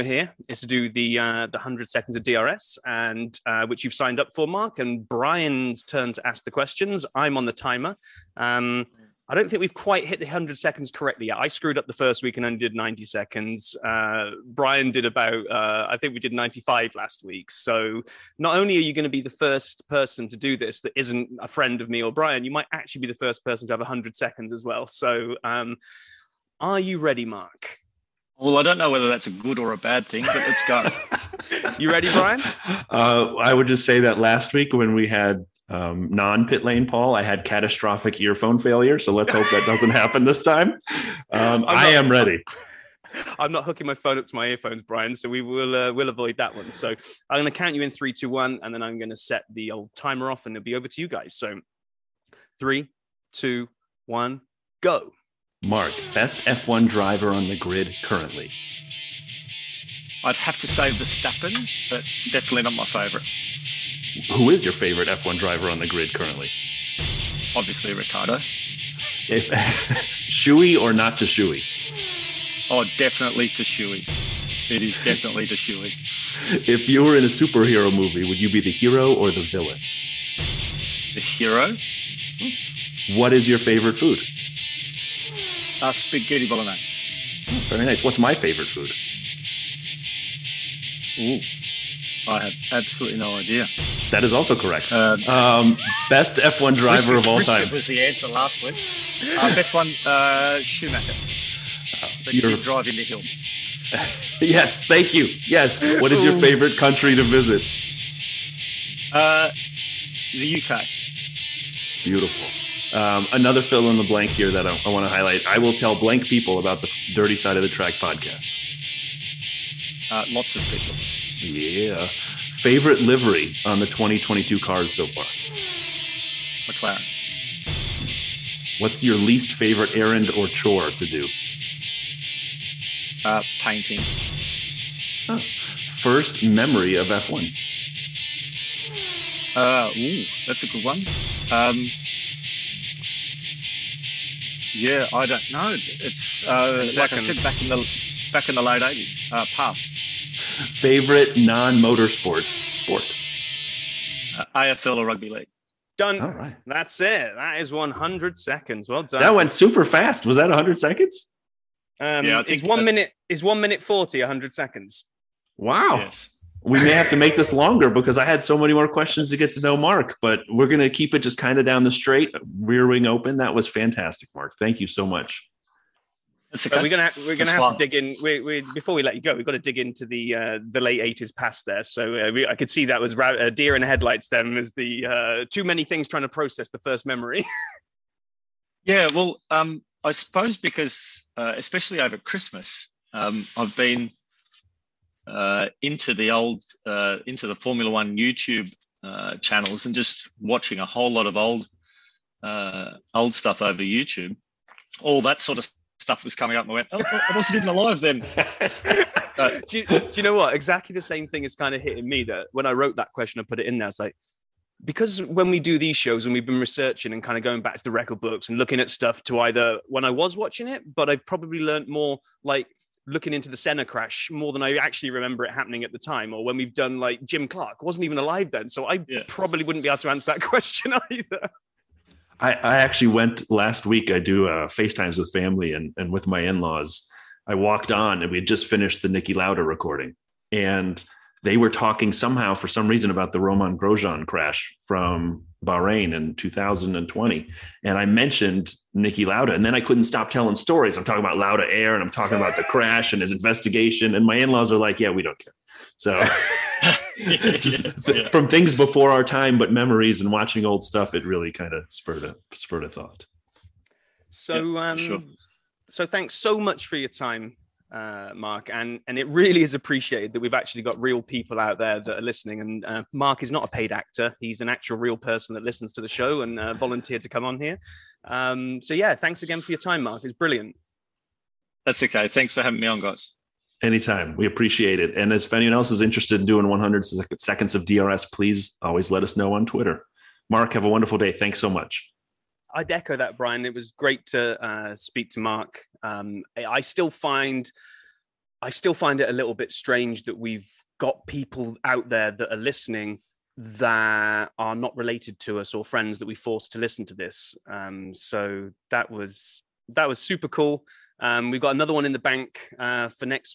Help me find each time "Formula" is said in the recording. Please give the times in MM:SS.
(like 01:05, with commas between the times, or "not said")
03:17.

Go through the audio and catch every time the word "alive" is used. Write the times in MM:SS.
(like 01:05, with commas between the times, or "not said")
03:27, 03:48.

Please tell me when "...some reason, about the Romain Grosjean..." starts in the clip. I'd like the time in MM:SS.
04:02.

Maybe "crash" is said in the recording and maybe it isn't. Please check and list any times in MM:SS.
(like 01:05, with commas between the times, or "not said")
03:43, 04:04, 04:12.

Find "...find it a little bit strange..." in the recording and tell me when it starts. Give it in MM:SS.
04:58.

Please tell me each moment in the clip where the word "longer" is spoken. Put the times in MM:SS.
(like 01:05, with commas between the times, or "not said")
02:47.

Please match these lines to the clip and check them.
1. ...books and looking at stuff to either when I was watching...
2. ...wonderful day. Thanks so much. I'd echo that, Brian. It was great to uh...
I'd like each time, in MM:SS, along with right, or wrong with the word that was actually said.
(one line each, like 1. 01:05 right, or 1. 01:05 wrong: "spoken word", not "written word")
1. 03:38 right
2. 04:50 right.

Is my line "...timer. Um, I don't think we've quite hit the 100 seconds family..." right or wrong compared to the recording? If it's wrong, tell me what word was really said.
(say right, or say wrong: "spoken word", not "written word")
wrong: "correctly", not "family".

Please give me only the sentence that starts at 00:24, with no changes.
So um, are you ready, Mark?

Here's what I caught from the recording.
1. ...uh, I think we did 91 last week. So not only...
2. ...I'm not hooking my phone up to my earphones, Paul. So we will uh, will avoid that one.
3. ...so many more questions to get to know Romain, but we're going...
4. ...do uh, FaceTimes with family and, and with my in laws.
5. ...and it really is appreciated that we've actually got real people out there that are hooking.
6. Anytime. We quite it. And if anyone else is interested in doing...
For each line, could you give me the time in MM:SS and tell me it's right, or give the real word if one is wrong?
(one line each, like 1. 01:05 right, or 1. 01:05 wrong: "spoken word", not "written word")
1. 00:15 wrong: "95", not "91"
2. 00:43 wrong: "Brian", not "Paul"
3. 02:48 wrong: "Mark", not "Romain"
4. 03:54 right
5. 04:29 wrong: "listening", not "hooking"
6. 04:43 wrong: "appreciate", not "quite".